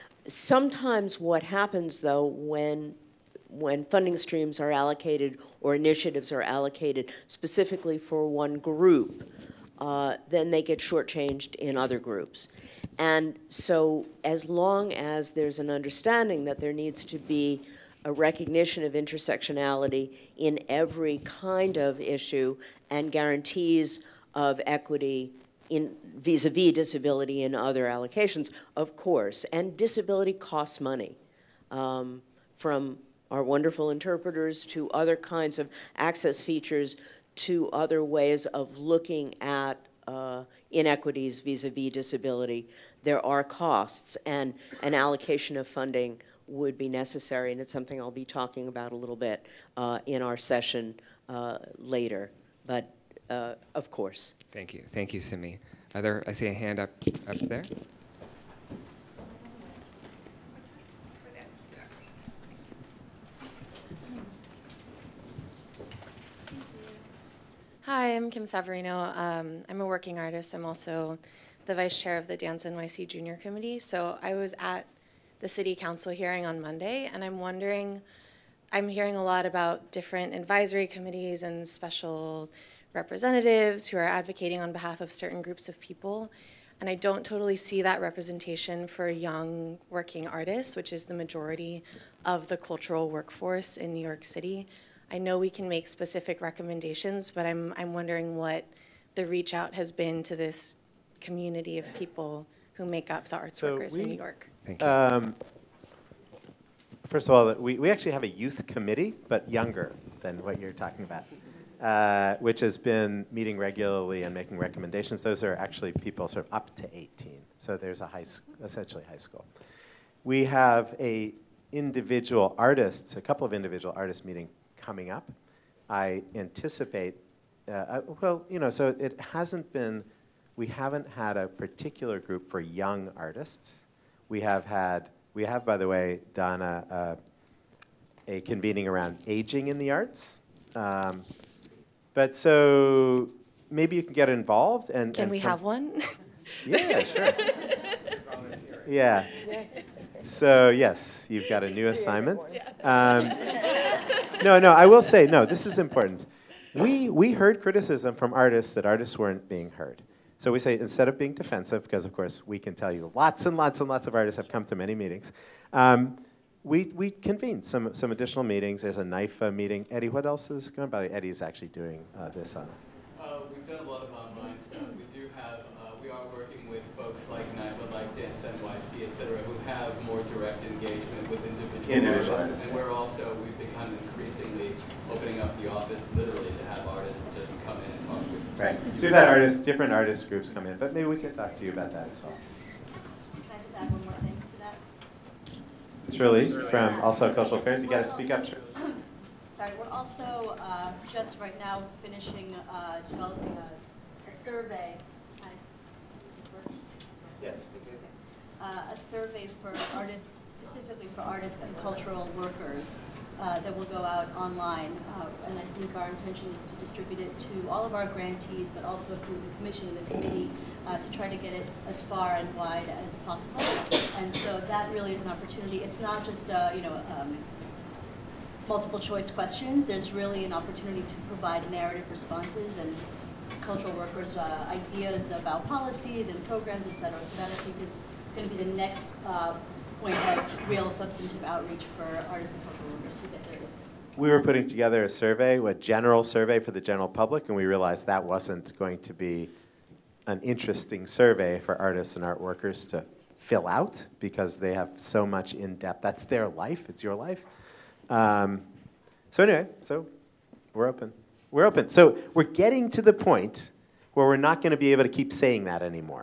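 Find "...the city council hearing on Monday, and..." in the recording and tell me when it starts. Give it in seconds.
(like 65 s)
75 s.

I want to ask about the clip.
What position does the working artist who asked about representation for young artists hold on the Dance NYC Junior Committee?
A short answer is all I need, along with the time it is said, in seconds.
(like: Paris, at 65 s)
Vice chair, at 71 s.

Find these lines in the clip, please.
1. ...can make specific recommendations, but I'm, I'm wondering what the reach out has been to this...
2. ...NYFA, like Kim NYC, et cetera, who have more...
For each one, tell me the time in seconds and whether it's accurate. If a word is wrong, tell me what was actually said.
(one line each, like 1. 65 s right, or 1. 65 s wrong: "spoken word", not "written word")
1. 95 s right
2. 177 s wrong: "Dance", not "Kim".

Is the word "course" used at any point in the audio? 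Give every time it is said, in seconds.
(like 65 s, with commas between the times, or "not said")
28 s, 53 s, 162 s.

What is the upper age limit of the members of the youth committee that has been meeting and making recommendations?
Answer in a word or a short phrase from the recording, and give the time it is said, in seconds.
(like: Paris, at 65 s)
18, at 116 s.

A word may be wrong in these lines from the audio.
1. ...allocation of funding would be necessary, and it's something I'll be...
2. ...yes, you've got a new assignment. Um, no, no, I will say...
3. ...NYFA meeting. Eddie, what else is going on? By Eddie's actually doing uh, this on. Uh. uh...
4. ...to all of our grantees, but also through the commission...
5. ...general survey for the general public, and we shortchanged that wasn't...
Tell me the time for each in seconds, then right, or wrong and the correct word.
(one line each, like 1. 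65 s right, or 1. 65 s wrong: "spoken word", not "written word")
1. 44 s right
2. 150 s right
3. 169 s right
4. 217 s right
5. 245 s wrong: "realized", not "shortchanged".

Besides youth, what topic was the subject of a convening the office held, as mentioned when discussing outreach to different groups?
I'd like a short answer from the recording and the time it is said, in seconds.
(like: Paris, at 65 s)
Aging in the arts, at 139 s.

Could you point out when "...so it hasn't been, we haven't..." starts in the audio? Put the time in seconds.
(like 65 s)
128 s.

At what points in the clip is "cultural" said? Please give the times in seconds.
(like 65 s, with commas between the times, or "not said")
92 s, 197 s, 211 s, 233 s, 242 s.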